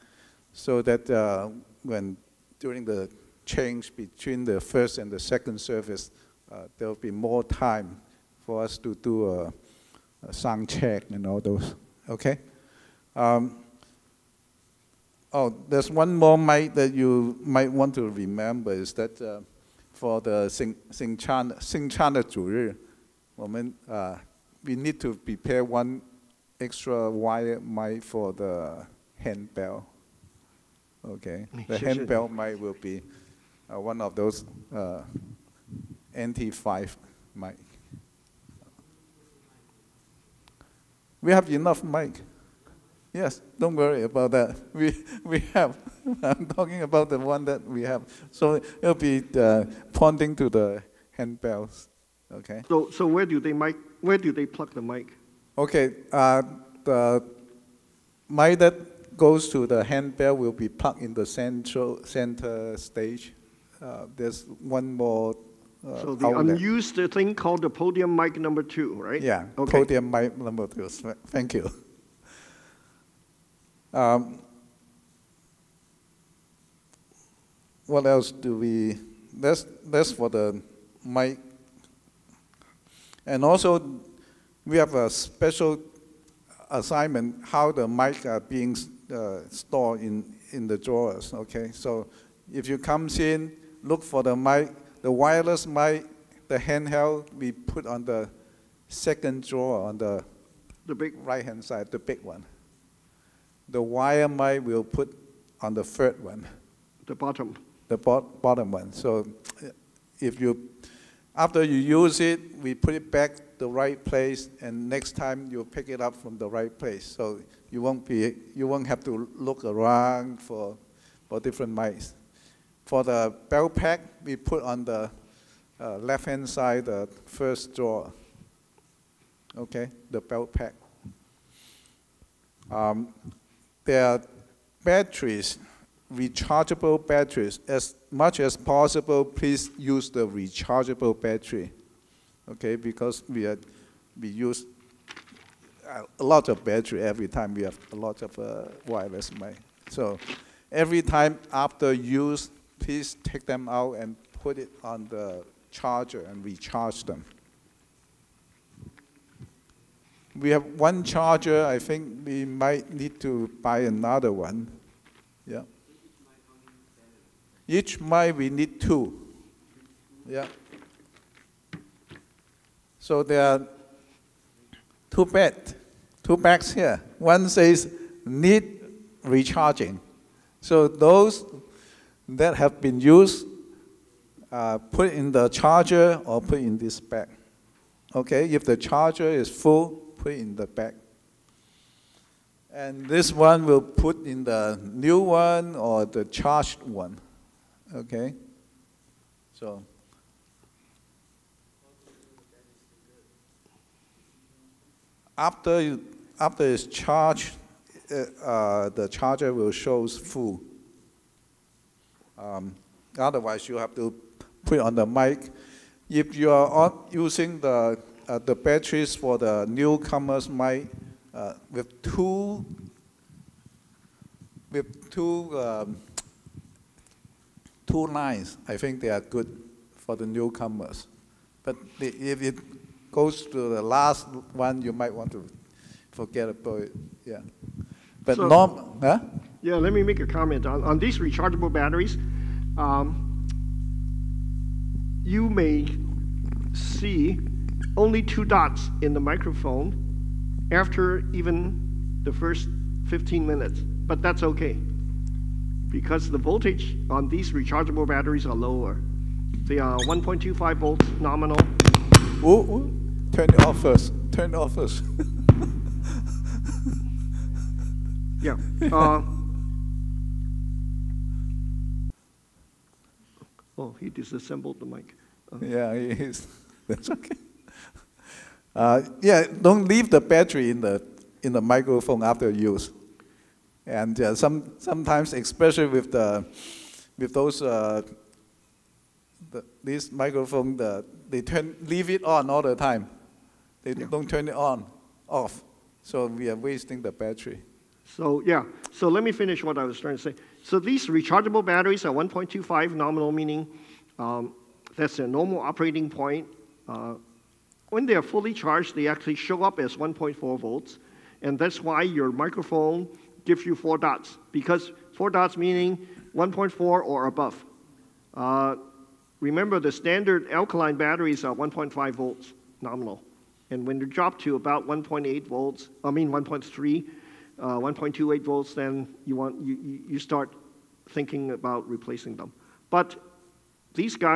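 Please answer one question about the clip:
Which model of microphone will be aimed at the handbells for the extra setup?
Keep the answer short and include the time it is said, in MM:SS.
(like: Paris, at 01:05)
NT5, at 00:36.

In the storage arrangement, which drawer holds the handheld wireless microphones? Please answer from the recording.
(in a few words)
second drawer.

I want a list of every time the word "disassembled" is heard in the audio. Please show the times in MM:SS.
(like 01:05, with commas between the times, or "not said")
04:34.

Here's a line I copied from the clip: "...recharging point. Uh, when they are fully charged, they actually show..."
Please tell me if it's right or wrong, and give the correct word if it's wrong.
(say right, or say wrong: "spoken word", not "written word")
wrong: "operating", not "recharging".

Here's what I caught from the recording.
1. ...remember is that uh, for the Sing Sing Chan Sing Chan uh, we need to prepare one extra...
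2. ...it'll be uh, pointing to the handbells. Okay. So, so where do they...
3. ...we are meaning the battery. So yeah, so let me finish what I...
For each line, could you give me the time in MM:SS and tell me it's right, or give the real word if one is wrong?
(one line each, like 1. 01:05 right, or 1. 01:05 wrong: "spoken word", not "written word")
1. 00:18 right
2. 00:48 right
3. 04:56 wrong: "wasting", not "meaning".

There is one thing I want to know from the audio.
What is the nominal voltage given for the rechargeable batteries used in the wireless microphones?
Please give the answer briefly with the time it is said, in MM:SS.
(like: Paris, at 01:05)
1.25 volts, at 04:19.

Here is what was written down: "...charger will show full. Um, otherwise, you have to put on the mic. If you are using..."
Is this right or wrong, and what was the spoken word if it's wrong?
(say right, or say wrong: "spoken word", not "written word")
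right.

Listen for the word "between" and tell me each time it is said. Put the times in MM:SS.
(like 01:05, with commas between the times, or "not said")
00:03.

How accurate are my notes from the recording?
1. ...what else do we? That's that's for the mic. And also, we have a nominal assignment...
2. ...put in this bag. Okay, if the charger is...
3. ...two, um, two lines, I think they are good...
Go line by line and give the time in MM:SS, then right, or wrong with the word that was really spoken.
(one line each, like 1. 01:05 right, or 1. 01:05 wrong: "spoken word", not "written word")
1. 01:17 wrong: "special", not "nominal"
2. 03:06 right
3. 03:45 right.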